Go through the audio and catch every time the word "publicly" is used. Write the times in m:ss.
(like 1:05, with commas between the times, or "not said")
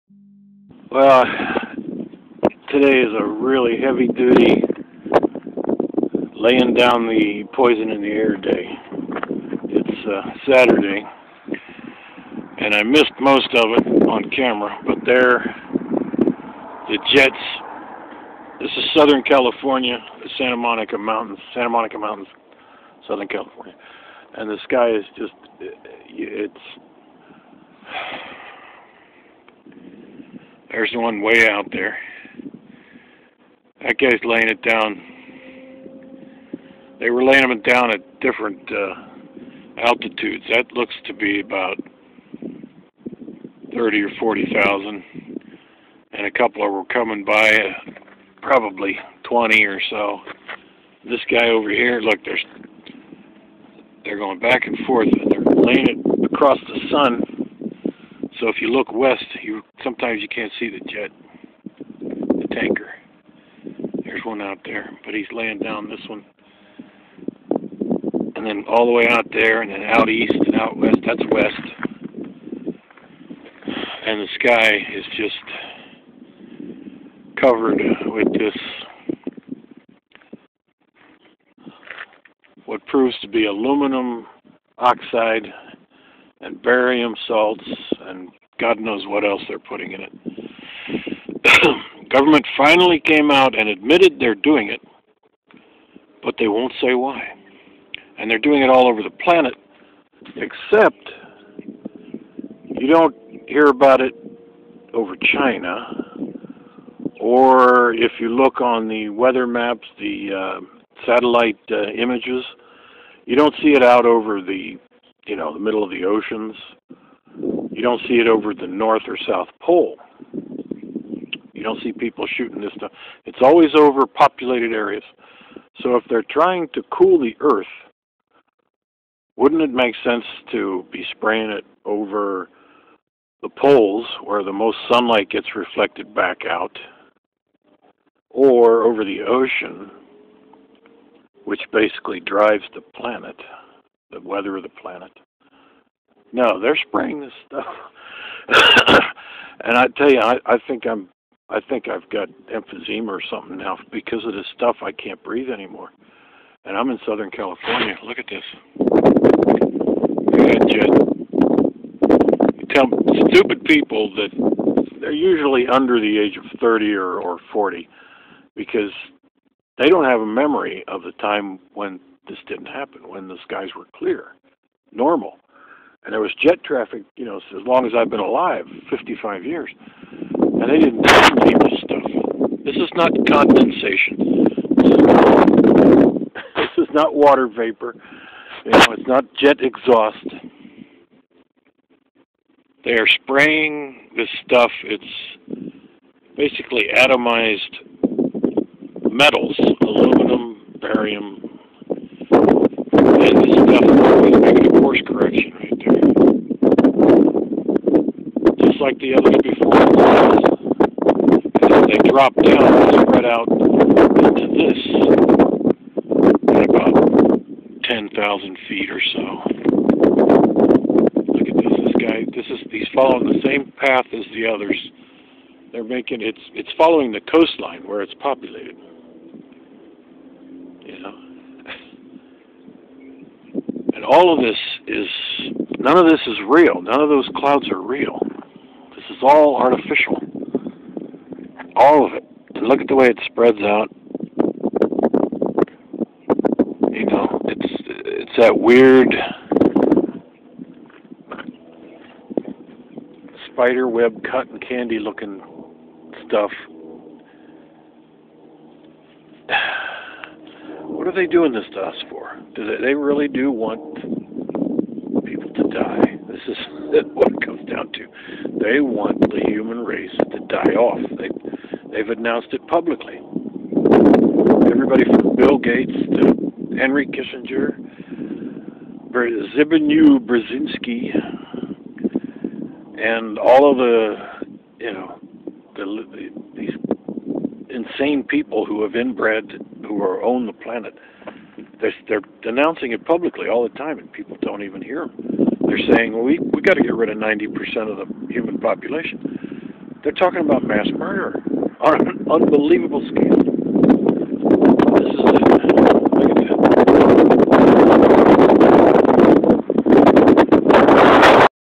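4:32, 4:53.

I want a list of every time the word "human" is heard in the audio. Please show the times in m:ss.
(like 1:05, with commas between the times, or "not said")
4:29, 4:58.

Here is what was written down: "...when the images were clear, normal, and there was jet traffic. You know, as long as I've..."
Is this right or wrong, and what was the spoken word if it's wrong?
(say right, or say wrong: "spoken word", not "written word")
wrong: "skies", not "images".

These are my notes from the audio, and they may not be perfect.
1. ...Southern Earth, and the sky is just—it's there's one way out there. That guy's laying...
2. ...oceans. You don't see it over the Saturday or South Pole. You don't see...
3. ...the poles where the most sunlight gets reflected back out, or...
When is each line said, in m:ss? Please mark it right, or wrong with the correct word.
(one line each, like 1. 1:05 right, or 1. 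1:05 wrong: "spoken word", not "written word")
1. 0:23 wrong: "California", not "Earth"
2. 1:56 wrong: "North", not "Saturday"
3. 2:13 right.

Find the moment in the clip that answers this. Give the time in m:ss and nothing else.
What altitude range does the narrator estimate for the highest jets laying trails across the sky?
0:43.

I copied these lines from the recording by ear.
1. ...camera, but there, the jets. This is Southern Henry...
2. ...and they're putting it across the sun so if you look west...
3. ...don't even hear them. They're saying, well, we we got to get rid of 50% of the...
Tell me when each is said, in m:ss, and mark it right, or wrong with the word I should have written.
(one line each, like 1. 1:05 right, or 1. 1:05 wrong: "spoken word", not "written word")
1. 0:14 wrong: "California", not "Henry"
2. 0:55 wrong: "laying", not "putting"
3. 4:54 wrong: "90", not "50".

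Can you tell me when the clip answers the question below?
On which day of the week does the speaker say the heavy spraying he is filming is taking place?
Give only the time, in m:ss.
0:10.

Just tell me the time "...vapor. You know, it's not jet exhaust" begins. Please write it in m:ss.
3:07.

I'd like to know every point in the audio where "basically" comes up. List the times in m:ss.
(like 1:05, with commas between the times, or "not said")
2:21, 3:16.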